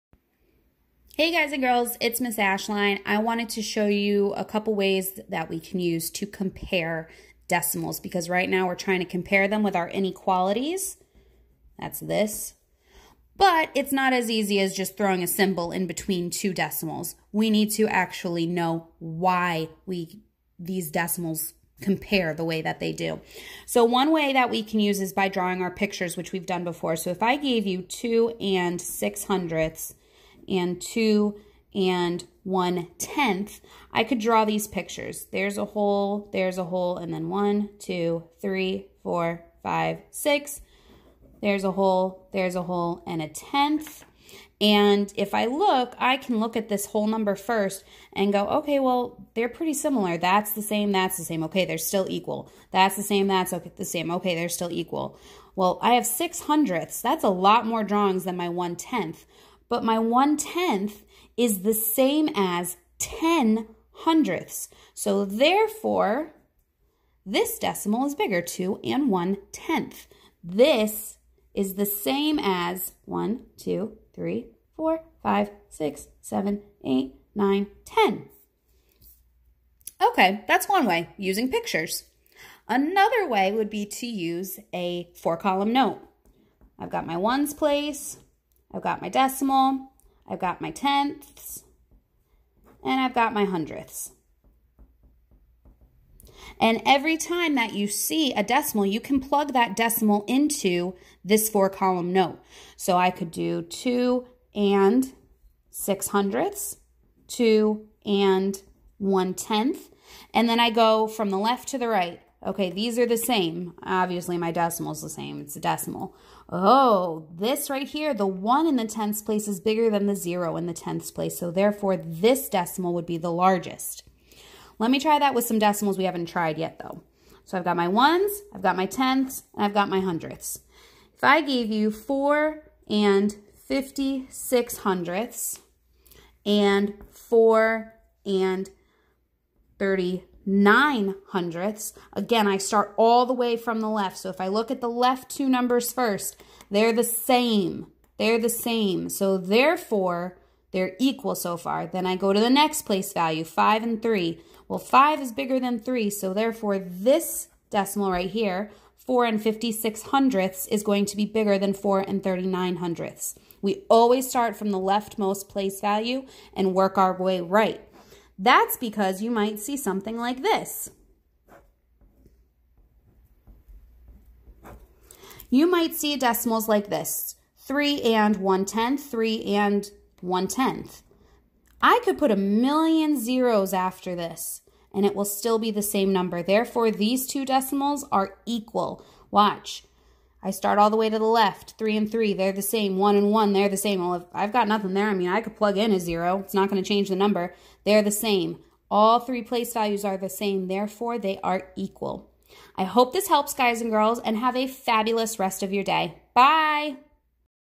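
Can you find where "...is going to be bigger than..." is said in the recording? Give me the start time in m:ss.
2:40.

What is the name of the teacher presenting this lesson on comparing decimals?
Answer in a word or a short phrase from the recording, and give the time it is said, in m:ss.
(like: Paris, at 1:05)
Miss Ashline, at 0:02.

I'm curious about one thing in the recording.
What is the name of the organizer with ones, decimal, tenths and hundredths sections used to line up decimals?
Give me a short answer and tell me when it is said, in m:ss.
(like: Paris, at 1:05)
four-column note, at 1:25.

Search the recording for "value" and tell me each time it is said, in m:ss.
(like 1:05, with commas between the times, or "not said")
2:33, 2:45, 3:19.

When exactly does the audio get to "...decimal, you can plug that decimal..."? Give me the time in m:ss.
1:38.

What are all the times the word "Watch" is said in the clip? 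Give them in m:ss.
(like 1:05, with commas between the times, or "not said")
3:09.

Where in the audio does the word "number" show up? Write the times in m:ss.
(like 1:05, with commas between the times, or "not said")
0:47, 2:25, 3:06, 3:17.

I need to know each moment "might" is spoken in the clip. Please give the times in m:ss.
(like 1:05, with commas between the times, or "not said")
2:49, 2:55.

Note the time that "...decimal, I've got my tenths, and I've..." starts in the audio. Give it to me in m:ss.
1:29.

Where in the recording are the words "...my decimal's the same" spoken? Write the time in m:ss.
1:54.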